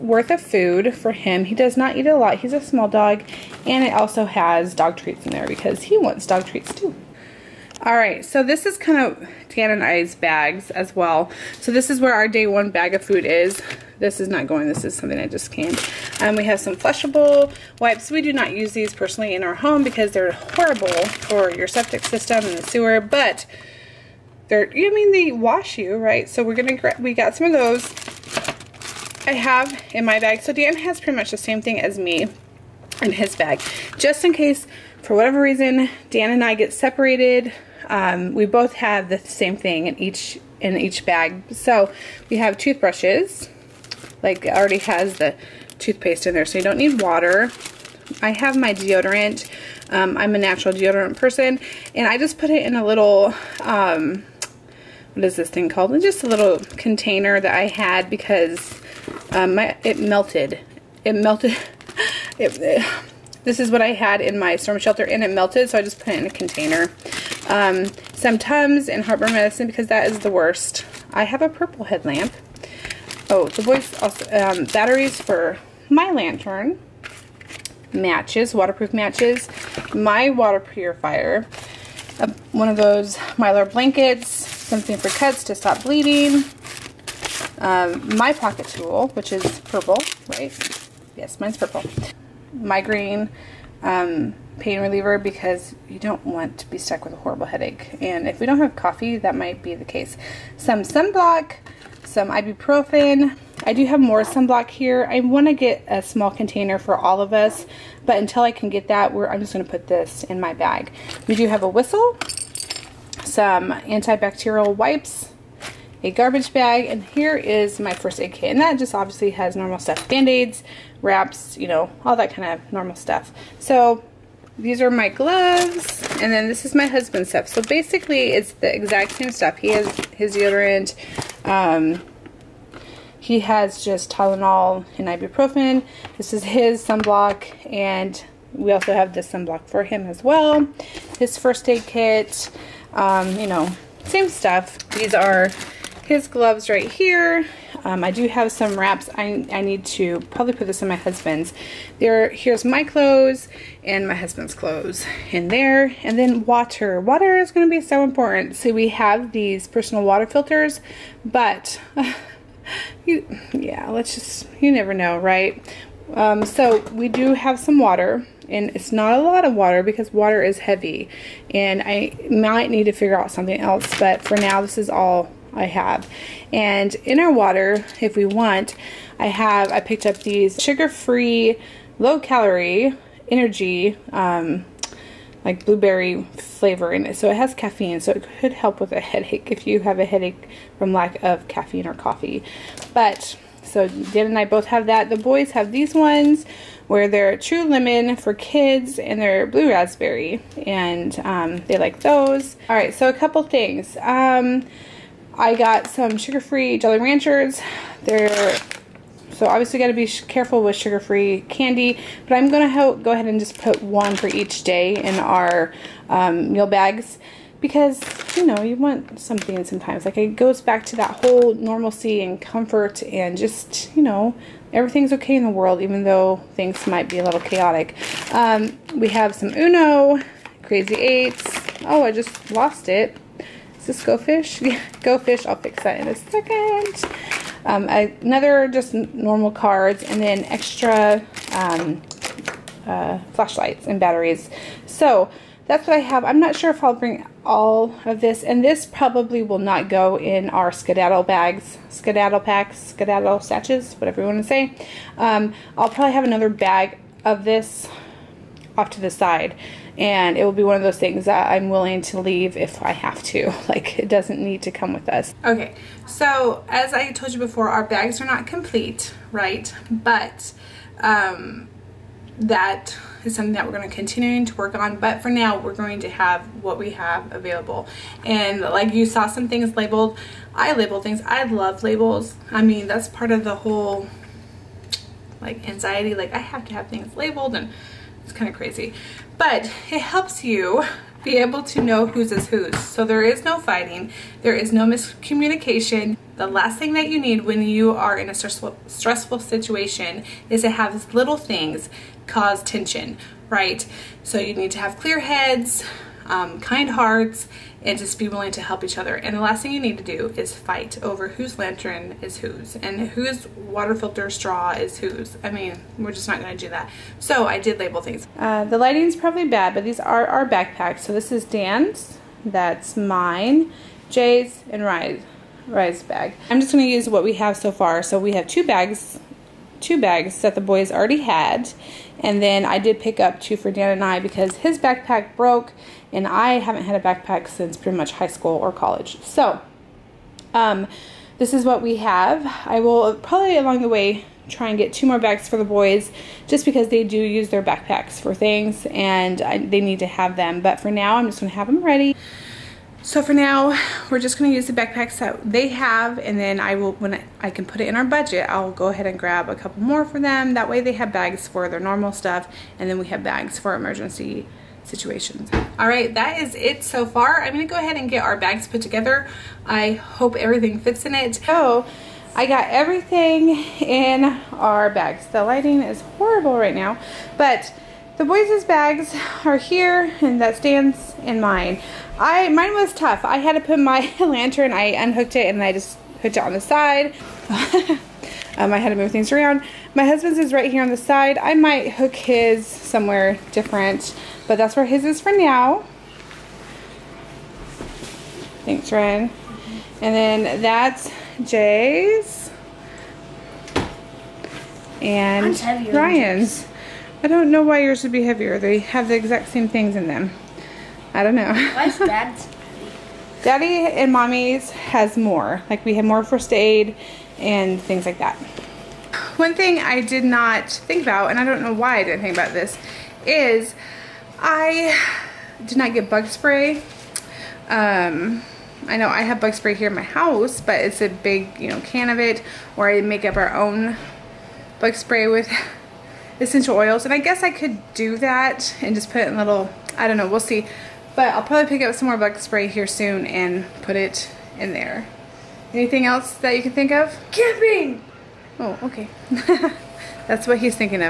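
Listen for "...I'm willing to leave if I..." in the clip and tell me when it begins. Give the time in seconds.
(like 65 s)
261 s.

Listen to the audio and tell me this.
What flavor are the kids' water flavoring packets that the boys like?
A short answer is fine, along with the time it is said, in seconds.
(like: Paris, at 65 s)
Blue raspberry, at 199 s.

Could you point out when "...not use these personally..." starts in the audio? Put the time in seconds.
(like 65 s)
18 s.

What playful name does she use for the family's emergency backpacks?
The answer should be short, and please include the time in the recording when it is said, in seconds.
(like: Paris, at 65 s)
Skedaddle bags, at 250 s.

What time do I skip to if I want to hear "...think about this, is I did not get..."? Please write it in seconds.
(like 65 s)
422 s.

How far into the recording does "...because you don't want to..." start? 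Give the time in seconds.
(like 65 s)
95 s.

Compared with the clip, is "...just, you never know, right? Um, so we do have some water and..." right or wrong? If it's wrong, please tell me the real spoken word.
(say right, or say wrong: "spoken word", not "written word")
right.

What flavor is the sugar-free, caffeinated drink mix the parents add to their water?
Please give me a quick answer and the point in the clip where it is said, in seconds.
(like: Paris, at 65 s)
Blueberry, at 185 s.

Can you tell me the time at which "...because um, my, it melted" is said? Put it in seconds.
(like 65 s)
58 s.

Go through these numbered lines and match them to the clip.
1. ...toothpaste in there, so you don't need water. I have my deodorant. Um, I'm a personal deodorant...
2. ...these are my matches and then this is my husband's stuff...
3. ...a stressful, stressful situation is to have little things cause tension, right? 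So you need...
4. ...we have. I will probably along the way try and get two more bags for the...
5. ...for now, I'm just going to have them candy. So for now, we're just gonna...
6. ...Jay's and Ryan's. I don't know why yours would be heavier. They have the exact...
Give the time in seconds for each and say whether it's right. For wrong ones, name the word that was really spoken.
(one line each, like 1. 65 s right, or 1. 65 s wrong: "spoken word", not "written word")
1. 45 s wrong: "natural", not "personal"
2. 124 s wrong: "gloves", not "matches"
3. 298 s right
4. 341 s right
5. 350 s wrong: "ready", not "candy"
6. 401 s right.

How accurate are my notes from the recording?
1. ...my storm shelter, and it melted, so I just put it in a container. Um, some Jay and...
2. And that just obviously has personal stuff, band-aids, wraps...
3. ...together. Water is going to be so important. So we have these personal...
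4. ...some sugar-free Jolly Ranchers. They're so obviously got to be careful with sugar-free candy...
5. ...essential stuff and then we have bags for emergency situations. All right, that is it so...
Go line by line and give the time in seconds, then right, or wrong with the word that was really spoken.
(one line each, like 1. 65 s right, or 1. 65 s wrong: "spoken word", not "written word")
1. 64 s wrong: "Tums", not "Jay"
2. 118 s wrong: "normal", not "personal"
3. 156 s wrong: "water", not "together"
4. 205 s right
5. 361 s wrong: "normal", not "essential".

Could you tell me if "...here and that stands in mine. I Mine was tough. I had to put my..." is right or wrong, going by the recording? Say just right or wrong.
right.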